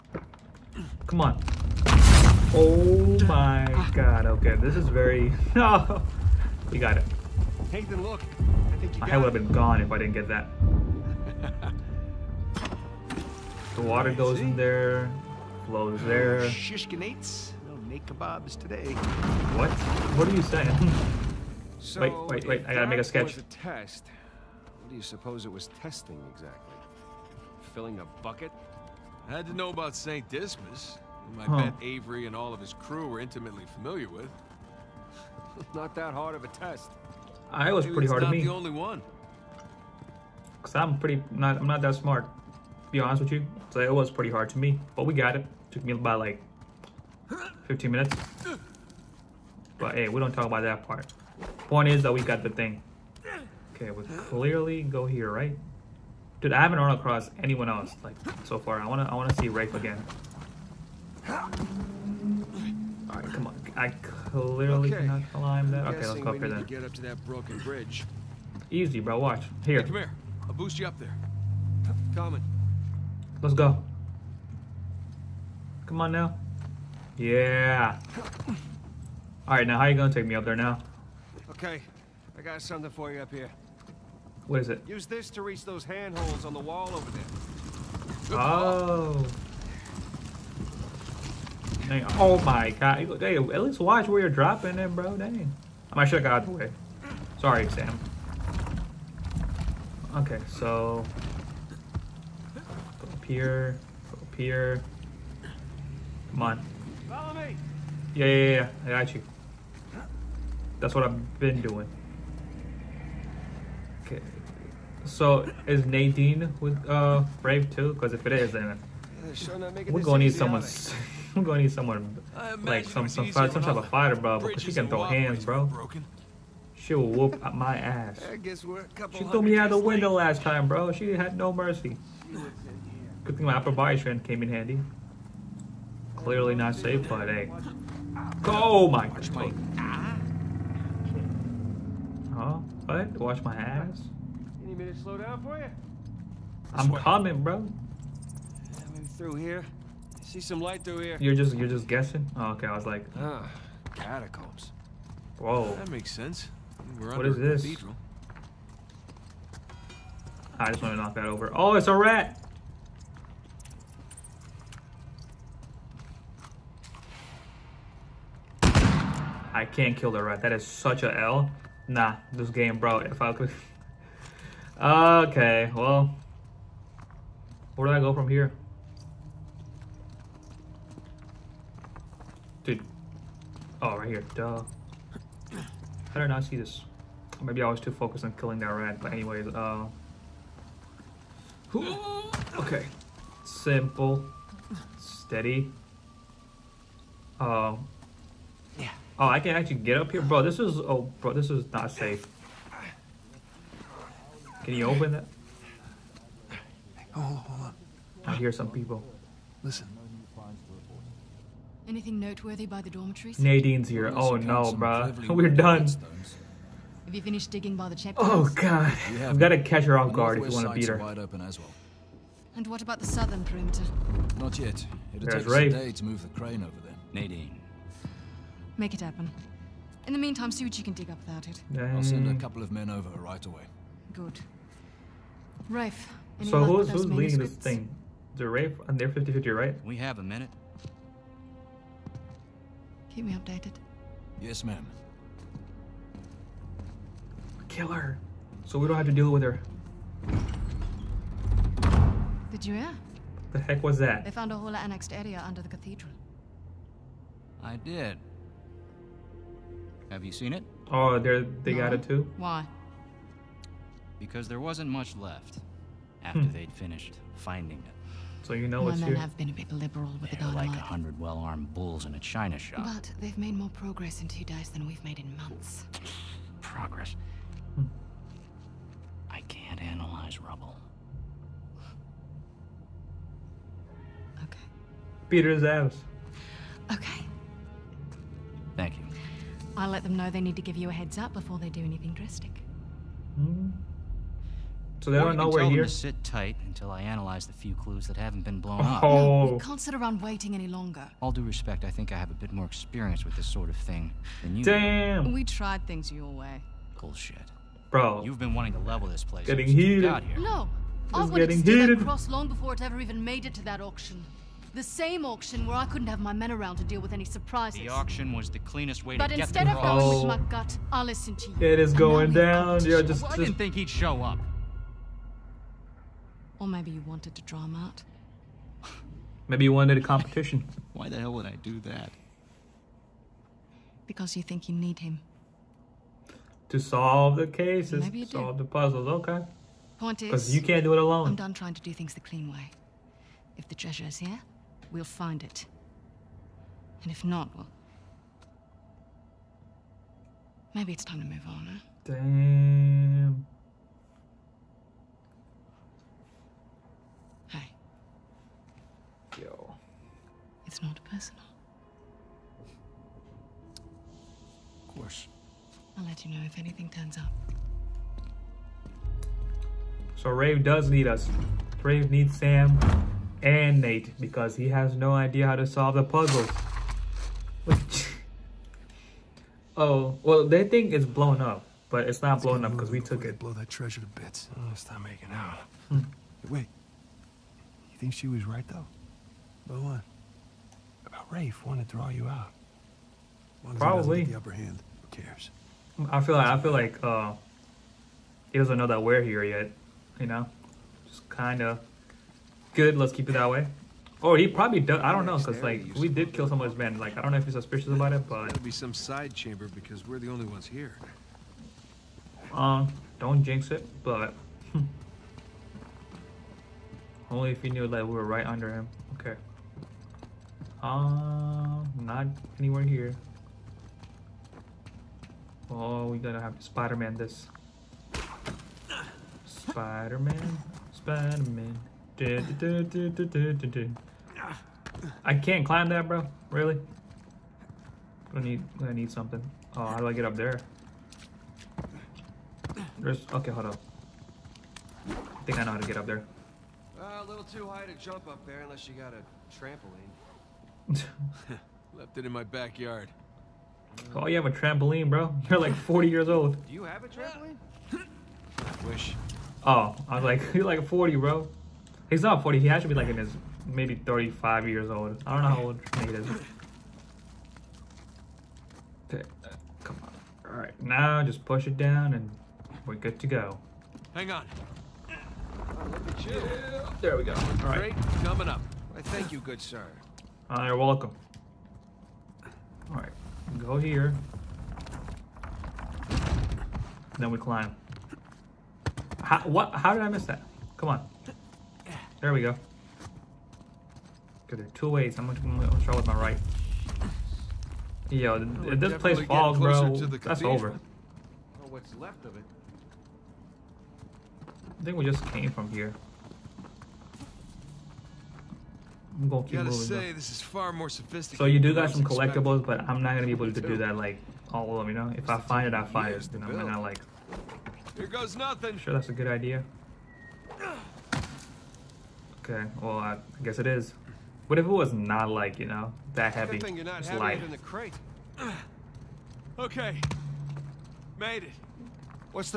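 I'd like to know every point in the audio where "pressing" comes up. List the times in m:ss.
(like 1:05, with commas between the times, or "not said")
not said.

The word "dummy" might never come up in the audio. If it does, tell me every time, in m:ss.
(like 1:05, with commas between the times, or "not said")
not said.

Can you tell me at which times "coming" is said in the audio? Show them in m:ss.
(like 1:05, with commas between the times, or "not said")
1:12, 2:26, 7:58.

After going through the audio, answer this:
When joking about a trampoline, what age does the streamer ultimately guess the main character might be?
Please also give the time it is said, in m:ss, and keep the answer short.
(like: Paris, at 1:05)
35, at 7:43.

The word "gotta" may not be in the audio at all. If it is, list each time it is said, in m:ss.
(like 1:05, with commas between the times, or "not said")
0:22, 7:06, 8:29.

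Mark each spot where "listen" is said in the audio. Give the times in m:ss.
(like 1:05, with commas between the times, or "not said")
3:29, 5:21.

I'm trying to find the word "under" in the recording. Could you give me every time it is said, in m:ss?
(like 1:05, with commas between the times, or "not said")
4:15, 6:58.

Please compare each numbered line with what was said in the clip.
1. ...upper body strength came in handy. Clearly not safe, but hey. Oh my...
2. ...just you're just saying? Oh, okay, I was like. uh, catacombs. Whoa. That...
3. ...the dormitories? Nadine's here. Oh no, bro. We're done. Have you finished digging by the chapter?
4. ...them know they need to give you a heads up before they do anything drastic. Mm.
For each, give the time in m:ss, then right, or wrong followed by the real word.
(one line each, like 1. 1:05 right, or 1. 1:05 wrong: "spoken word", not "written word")
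1. 2:13 right
2. 2:31 wrong: "guessing", not "saying"
3. 3:32 right
4. 4:50 right.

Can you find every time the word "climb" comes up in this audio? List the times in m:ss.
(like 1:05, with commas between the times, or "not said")
1:05, 7:15, 8:07.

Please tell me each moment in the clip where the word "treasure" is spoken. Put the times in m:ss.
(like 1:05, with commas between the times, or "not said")
5:43, 6:23.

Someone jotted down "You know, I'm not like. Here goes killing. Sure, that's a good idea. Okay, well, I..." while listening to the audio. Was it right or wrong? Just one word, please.
wrong.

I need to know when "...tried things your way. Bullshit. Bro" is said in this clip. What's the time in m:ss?
5:05.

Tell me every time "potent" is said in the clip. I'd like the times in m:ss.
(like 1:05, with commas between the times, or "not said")
not said.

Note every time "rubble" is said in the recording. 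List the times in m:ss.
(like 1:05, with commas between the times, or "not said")
4:40.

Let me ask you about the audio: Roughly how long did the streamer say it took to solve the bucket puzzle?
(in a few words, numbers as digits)
15 minutes.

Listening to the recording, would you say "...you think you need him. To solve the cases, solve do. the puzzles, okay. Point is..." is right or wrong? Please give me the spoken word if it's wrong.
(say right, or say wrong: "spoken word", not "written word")
right.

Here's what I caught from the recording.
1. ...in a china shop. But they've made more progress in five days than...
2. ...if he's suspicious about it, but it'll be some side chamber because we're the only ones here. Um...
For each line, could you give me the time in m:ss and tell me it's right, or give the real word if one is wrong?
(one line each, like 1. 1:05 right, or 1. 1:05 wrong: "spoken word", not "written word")
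1. 4:32 wrong: "two", not "five"
2. 6:47 right.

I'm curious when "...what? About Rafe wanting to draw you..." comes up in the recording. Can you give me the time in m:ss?
6:29.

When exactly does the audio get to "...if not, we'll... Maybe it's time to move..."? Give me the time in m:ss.
5:47.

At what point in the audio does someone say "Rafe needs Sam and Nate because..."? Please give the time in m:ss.
6:11.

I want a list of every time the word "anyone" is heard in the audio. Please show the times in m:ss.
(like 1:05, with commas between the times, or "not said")
0:57.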